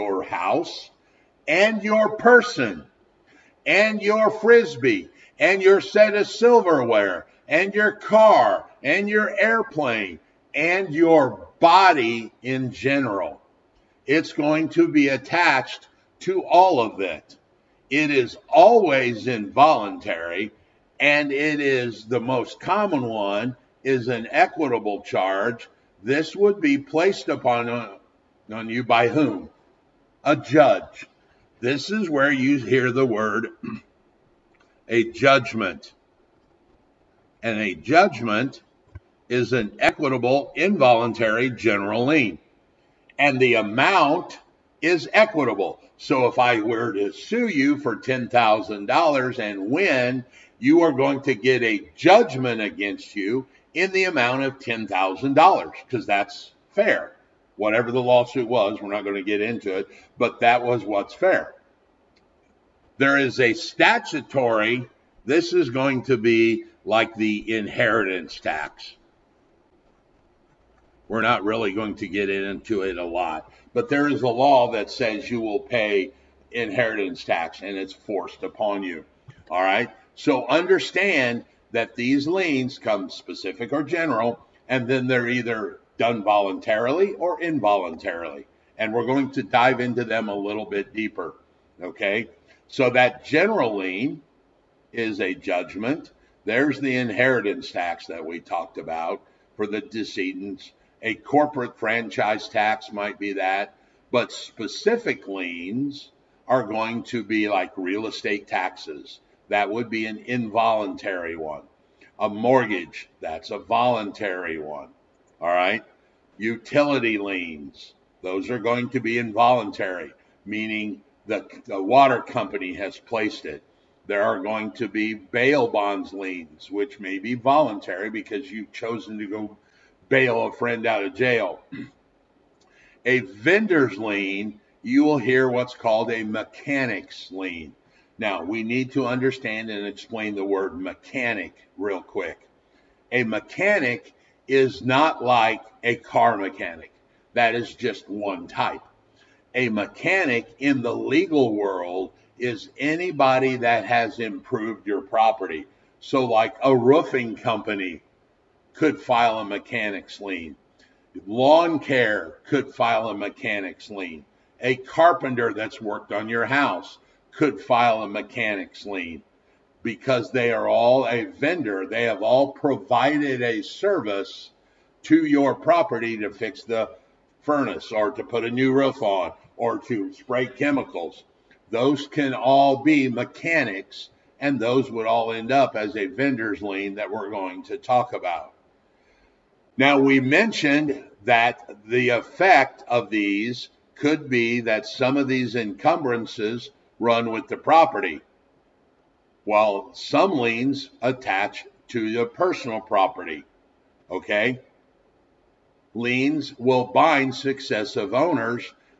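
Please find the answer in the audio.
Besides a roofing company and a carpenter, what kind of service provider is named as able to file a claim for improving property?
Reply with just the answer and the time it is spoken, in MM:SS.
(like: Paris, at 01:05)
Lawn care, at 02:41.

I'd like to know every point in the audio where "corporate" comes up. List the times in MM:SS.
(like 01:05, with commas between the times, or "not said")
01:41.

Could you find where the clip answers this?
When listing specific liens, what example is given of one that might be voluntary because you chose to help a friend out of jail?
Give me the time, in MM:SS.
02:05.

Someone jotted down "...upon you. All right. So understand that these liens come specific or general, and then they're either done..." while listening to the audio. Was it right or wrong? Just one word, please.
right.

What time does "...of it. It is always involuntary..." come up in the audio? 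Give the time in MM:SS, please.
00:16.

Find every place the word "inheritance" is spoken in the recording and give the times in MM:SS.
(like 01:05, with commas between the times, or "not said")
01:07, 01:16, 01:36.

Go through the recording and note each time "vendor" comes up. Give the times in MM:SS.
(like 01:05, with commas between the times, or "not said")
02:13, 02:51, 03:06.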